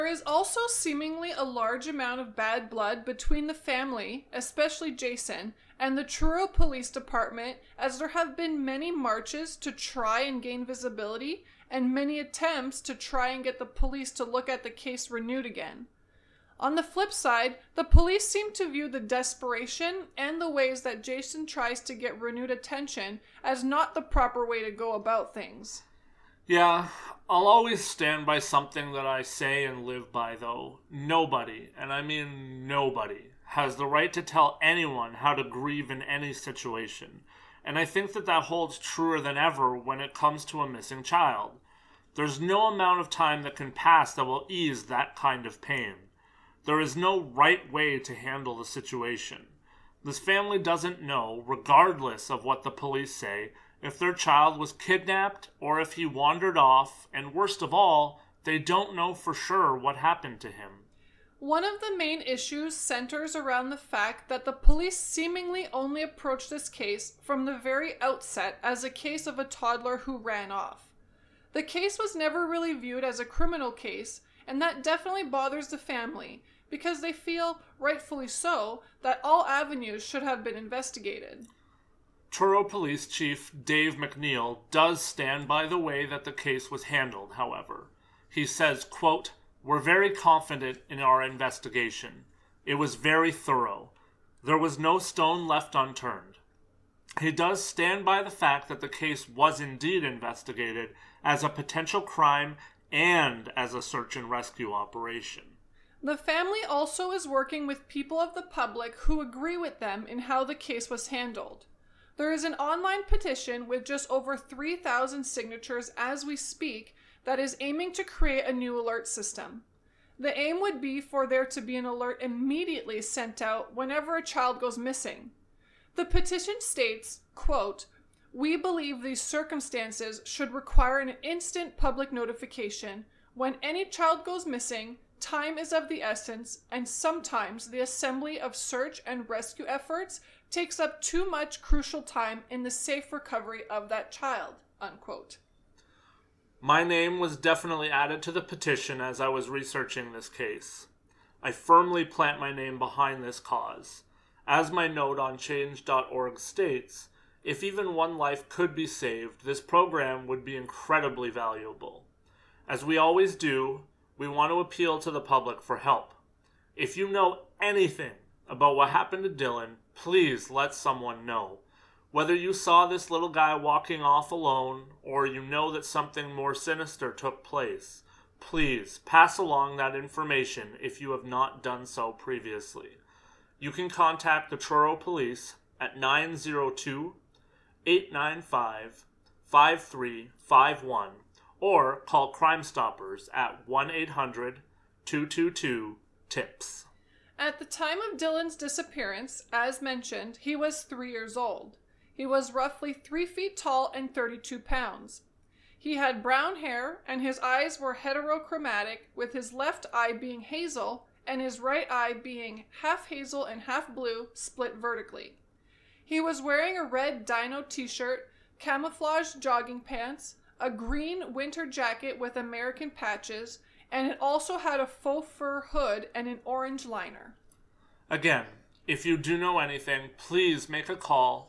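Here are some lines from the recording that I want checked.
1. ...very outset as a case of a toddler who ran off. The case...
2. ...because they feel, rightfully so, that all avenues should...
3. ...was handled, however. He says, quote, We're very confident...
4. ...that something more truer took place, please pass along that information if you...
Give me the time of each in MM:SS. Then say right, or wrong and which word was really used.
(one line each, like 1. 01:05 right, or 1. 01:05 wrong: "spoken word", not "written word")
1. 01:07 right
2. 01:16 right
3. 01:26 right
4. 02:55 wrong: "sinister", not "truer".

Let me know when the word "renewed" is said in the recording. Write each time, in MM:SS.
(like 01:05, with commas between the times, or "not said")
00:15, 00:22.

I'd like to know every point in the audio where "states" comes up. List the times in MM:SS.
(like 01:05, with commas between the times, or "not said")
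02:06, 02:36.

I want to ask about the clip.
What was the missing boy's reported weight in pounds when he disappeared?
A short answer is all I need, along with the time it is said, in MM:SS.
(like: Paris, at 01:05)
32, at 03:24.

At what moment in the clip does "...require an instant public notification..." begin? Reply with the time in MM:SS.
02:10.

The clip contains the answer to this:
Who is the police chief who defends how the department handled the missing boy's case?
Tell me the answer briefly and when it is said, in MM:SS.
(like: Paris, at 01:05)
Dave MacNeil, at 01:23.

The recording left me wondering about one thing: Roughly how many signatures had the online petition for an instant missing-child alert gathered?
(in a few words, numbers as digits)
3,000.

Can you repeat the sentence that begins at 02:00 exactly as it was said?
The aim would be for there to be an alert immediately sent out whenever a child goes missing.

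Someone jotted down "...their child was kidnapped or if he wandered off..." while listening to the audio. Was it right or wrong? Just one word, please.
right.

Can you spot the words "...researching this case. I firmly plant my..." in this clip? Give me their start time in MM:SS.
02:29.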